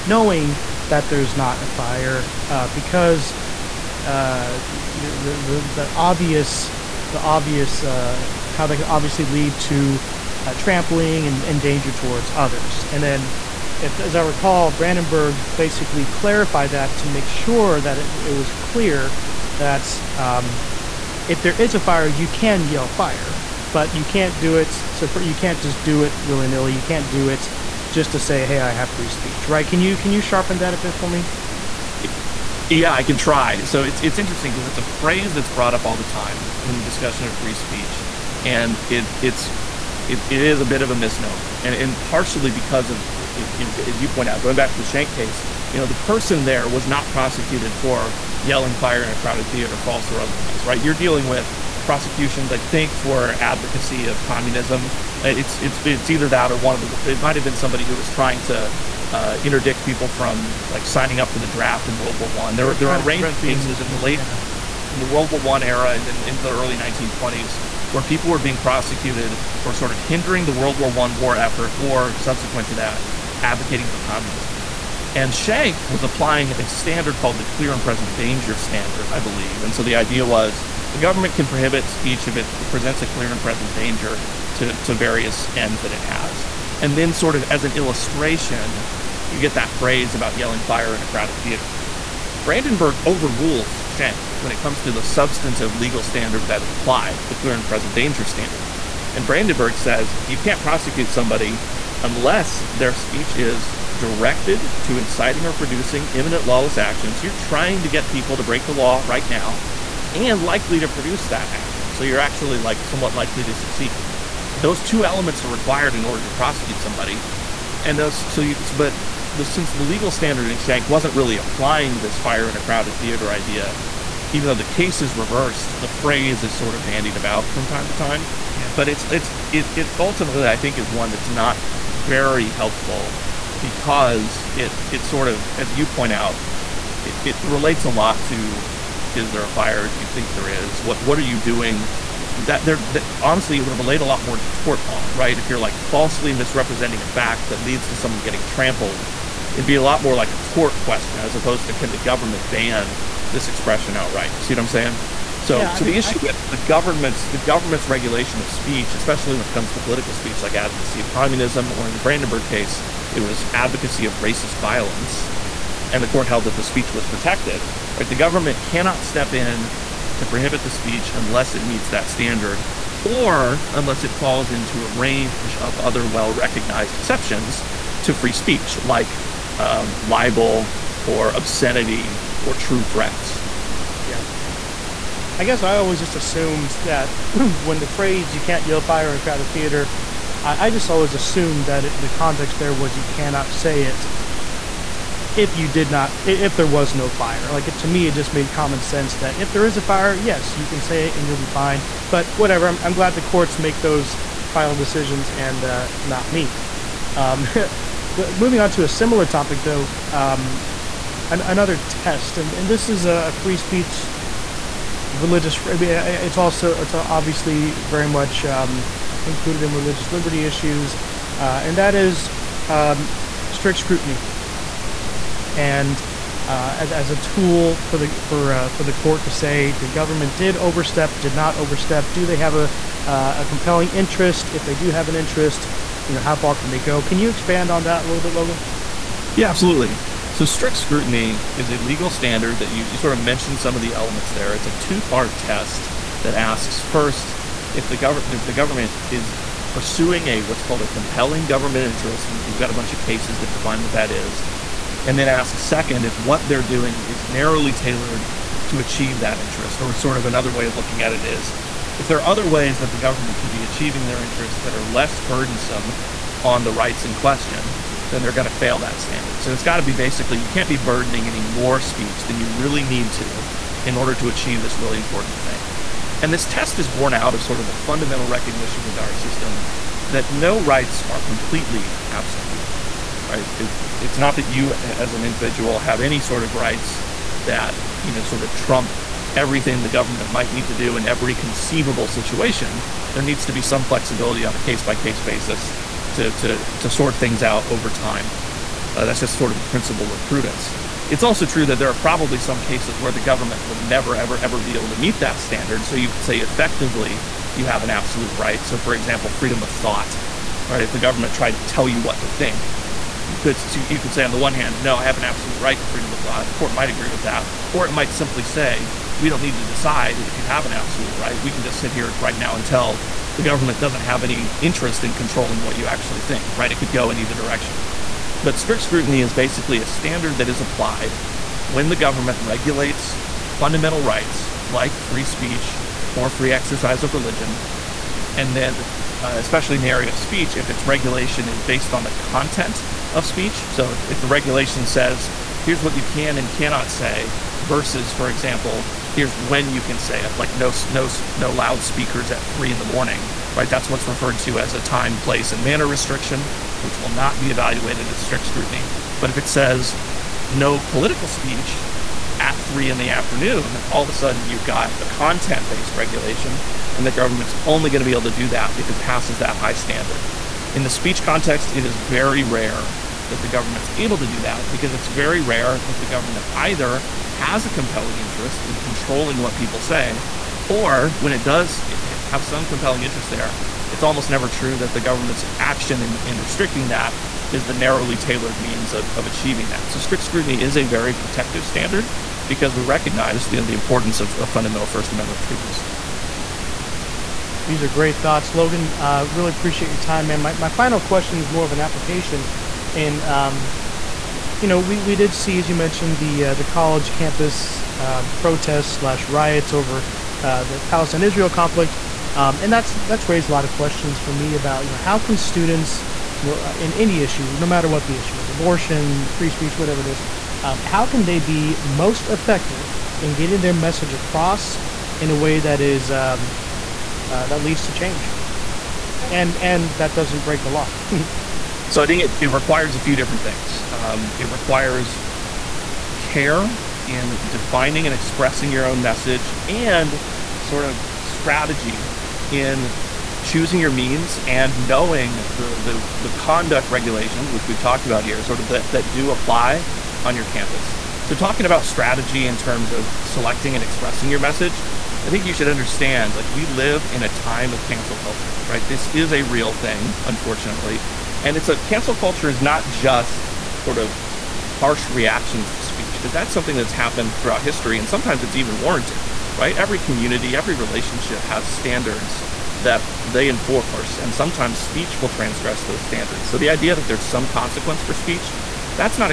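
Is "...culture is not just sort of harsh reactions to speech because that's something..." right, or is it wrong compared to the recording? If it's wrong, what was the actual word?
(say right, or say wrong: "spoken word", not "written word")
right.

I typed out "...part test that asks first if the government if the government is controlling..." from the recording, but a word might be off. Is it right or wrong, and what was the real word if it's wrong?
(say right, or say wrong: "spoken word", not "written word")
wrong: "pursuing", not "controlling".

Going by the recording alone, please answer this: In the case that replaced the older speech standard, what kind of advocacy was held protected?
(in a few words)
Racist violence.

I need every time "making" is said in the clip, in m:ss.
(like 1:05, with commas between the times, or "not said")
not said.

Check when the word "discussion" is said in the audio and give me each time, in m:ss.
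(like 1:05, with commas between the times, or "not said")
0:36.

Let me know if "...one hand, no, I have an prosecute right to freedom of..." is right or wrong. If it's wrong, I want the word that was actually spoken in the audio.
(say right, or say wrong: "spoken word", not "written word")
wrong: "absolute", not "prosecute".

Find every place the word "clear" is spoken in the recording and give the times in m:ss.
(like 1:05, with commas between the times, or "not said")
0:18, 1:17, 1:23, 1:37.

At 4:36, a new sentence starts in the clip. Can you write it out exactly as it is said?
And this test is born out of sort of the fundamental recognition within our system that no rights are completely absolute right?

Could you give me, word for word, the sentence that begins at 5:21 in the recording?
We can just sit here right now and tell the government doesn't have any interest in controlling what you actually think.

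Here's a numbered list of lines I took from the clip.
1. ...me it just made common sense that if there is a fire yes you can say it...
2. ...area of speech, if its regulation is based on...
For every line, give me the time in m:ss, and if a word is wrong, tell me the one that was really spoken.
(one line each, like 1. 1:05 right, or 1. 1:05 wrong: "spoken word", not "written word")
1. 3:17 right
2. 5:39 right.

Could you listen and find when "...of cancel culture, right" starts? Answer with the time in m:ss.
7:37.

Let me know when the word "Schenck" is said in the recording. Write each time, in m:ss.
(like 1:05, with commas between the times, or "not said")
0:44, 1:33, 2:00.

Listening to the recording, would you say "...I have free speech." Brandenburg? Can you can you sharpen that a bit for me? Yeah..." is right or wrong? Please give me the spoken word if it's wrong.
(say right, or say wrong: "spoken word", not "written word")
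wrong: "Right", not "Brandenburg".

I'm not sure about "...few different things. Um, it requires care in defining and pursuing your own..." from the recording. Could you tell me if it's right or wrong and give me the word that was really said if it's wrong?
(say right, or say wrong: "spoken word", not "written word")
wrong: "expressing", not "pursuing".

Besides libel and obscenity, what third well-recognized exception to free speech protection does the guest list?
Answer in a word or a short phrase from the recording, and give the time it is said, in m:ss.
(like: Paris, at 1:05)
True threats, at 3:02.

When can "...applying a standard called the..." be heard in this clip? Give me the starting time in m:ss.
1:16.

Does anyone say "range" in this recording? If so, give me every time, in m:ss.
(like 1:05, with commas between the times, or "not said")
1:03, 2:54.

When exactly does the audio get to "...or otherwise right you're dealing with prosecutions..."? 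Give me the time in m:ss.
0:50.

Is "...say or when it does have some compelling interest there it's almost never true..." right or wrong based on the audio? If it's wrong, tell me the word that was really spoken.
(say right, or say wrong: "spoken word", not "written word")
right.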